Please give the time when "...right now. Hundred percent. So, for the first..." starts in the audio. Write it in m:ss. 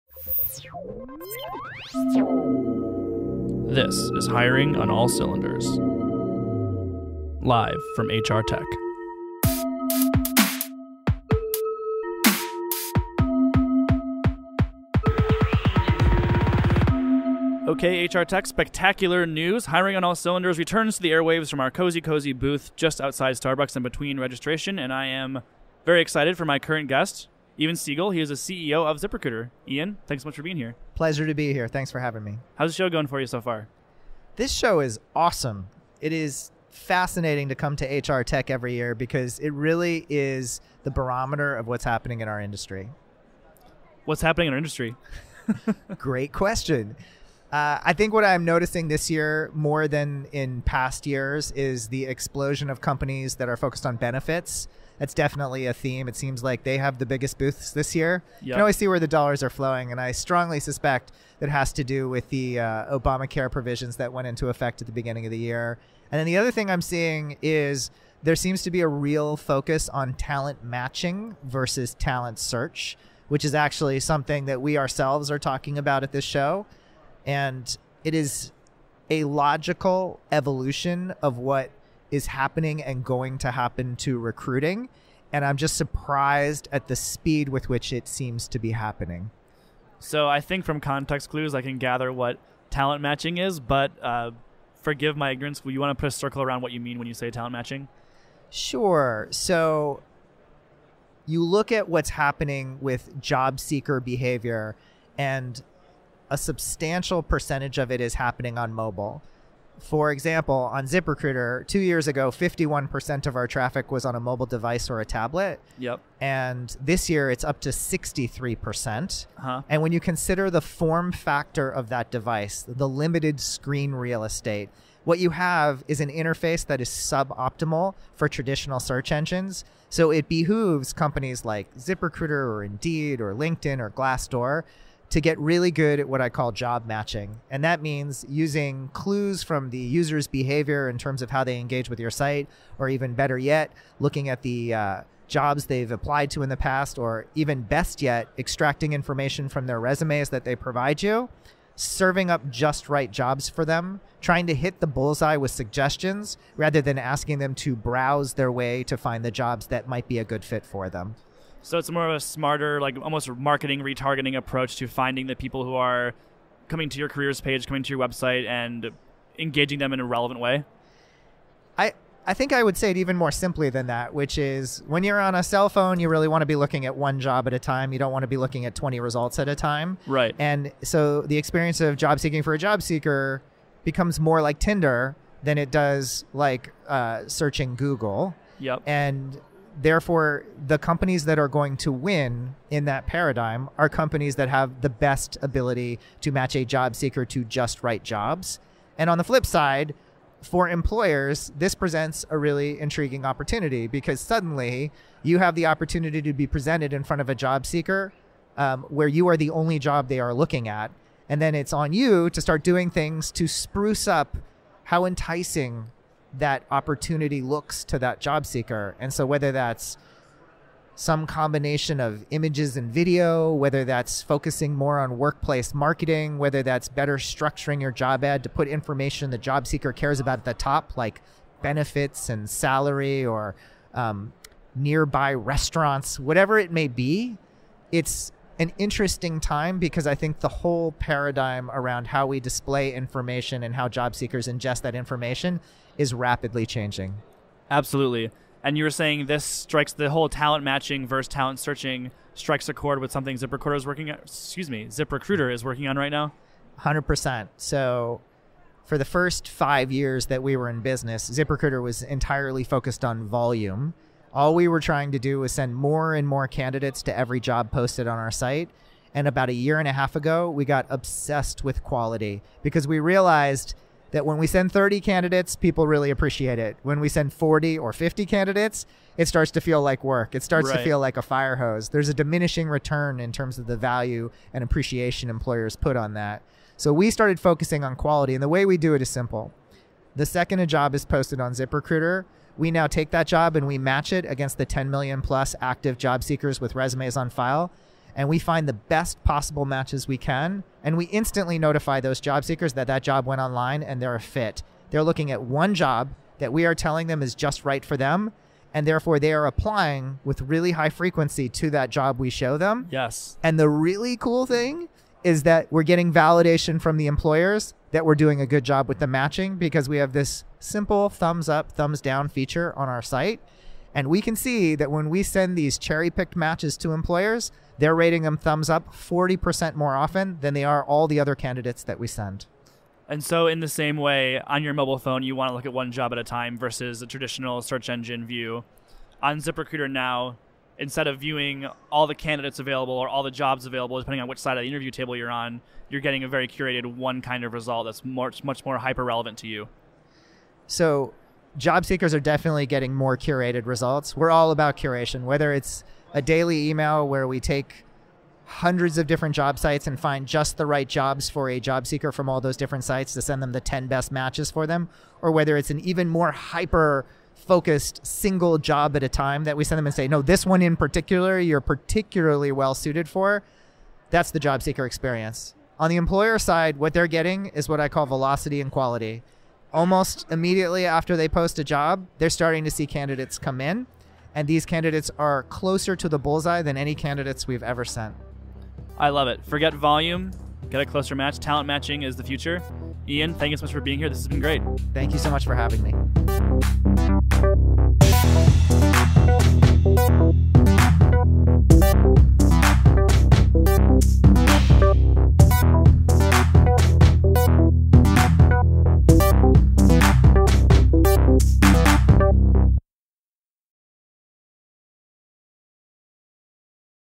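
4:15.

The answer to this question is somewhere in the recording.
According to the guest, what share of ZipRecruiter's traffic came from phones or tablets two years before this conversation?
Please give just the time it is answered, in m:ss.
1:52.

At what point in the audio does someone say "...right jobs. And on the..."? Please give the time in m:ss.
3:17.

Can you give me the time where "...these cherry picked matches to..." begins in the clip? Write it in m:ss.
5:25.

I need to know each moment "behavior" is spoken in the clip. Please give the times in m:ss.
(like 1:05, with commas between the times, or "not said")
1:44, 2:20.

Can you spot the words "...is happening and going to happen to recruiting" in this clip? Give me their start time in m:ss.
1:22.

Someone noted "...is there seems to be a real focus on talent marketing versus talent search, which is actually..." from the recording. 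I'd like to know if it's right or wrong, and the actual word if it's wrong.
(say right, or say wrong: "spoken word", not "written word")
wrong: "matching", not "marketing".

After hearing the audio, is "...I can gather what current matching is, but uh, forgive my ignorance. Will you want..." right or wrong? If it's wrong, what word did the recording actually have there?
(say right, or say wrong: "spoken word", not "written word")
wrong: "talent", not "current".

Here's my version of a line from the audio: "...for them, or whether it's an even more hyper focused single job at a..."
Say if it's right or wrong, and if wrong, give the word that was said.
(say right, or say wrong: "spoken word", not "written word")
right.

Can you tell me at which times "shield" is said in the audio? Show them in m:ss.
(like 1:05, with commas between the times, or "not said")
not said.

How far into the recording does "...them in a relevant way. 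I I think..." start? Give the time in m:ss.
2:49.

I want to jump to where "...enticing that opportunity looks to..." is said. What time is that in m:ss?
3:35.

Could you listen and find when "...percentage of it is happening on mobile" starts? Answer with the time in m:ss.
1:47.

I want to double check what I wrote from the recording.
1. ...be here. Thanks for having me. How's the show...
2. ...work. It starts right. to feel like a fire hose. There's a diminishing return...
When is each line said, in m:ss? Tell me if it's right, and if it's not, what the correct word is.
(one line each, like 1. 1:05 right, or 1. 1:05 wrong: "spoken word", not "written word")
1. 0:31 right
2. 4:40 right.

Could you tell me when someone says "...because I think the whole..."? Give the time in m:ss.
3:59.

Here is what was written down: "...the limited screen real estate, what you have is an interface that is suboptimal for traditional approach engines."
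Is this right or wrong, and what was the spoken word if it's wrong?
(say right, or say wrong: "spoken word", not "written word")
wrong: "search", not "approach".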